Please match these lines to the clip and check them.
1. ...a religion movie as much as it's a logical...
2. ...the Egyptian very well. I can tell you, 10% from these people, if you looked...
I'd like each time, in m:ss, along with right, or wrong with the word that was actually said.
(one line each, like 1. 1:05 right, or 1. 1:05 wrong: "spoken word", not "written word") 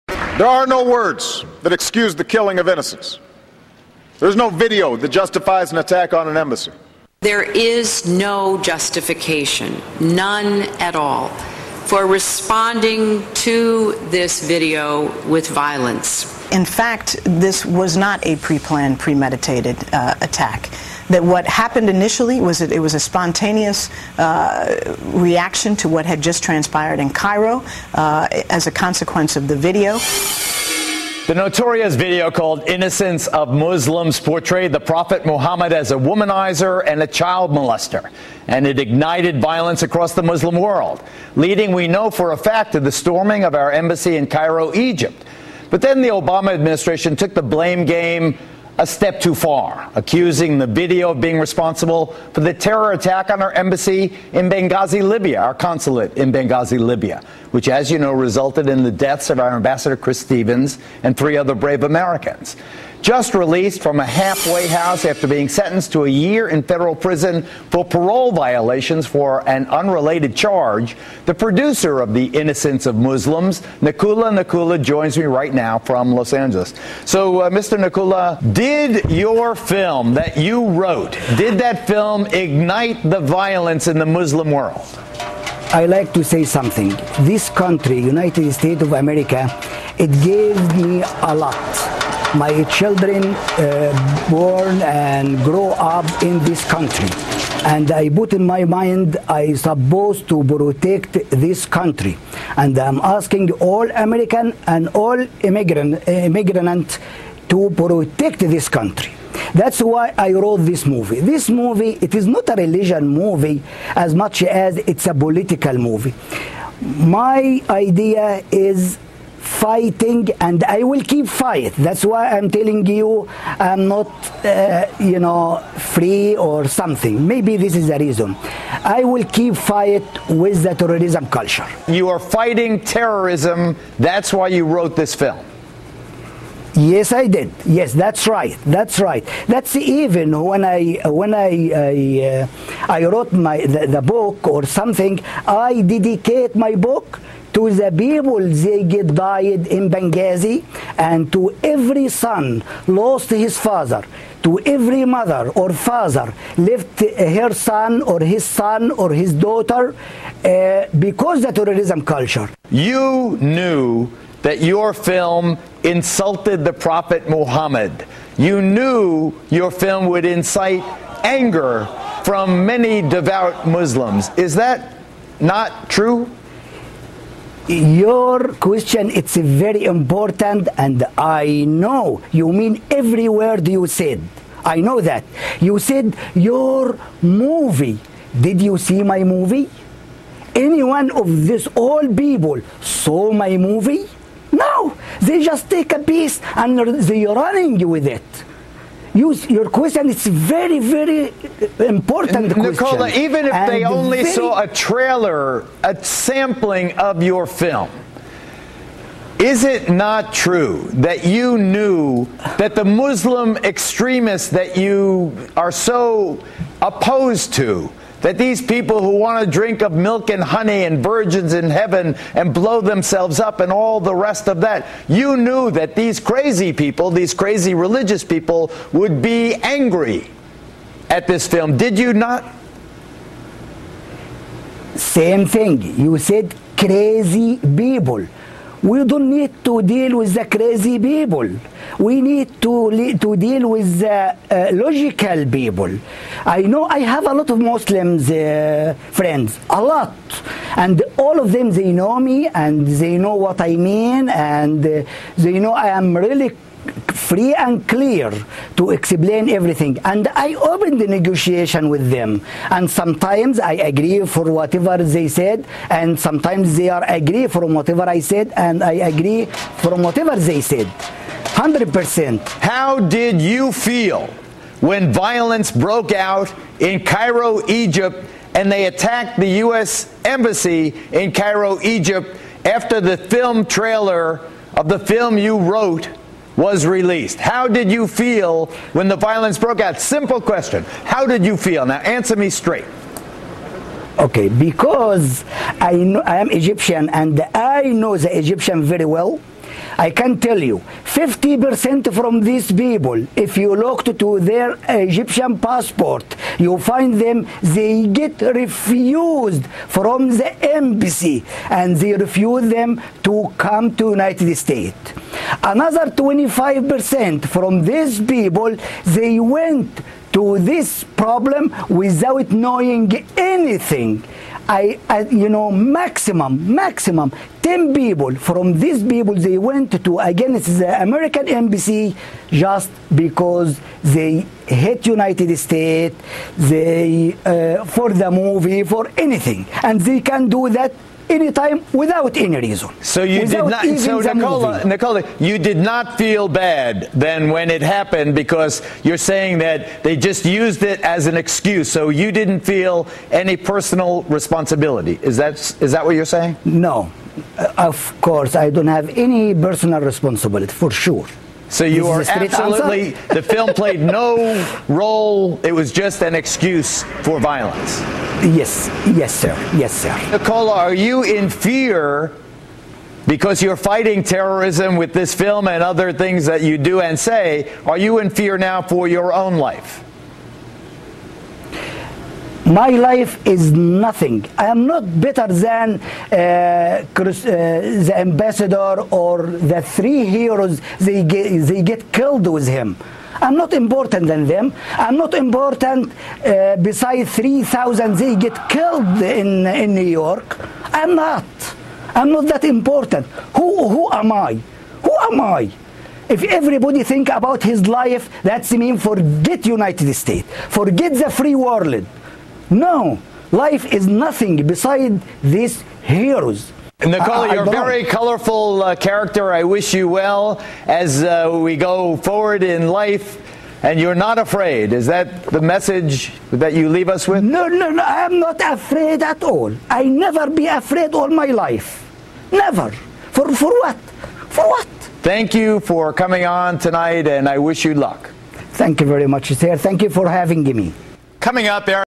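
1. 1:52 wrong: "political", not "logical"
2. 4:58 wrong: "50", not "10".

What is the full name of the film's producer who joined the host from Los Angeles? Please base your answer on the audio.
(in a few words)
Nakoula Nakoula.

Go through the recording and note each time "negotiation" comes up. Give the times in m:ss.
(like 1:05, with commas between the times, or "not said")
4:21.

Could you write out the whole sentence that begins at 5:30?
it's the American embassy just because they hate United States, they, uh, for the movie, for anything.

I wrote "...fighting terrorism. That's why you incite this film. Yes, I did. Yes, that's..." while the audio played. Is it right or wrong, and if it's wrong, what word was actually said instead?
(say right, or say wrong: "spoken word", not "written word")
wrong: "wrote", not "incite".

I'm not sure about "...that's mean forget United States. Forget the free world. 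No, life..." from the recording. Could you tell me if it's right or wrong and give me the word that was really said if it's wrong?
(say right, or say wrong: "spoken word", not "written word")
right.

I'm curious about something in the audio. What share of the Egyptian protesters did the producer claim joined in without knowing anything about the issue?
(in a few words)
25%.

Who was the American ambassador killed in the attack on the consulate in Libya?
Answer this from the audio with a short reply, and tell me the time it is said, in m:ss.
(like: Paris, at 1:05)
Chris Stevens, at 0:59.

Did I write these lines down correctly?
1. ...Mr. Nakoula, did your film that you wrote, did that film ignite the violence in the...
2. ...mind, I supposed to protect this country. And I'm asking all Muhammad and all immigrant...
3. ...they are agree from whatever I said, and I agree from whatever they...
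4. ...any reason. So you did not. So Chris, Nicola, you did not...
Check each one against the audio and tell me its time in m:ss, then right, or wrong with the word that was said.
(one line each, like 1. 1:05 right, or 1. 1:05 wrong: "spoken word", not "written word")
1. 1:17 right
2. 1:38 wrong: "American", not "Muhammad"
3. 4:26 right
4. 5:42 wrong: "Nicola", not "Chris".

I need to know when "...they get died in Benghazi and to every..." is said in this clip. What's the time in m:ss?
2:28.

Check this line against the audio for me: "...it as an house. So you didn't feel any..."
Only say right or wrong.
wrong.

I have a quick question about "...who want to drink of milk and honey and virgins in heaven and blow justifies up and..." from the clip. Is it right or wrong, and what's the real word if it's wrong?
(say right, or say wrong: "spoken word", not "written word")
wrong: "themselves", not "justifies".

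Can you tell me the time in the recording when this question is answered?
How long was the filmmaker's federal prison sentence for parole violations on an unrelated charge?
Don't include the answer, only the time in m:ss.
1:06.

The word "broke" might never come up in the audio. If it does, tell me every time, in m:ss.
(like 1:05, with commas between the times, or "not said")
4:35, 4:49.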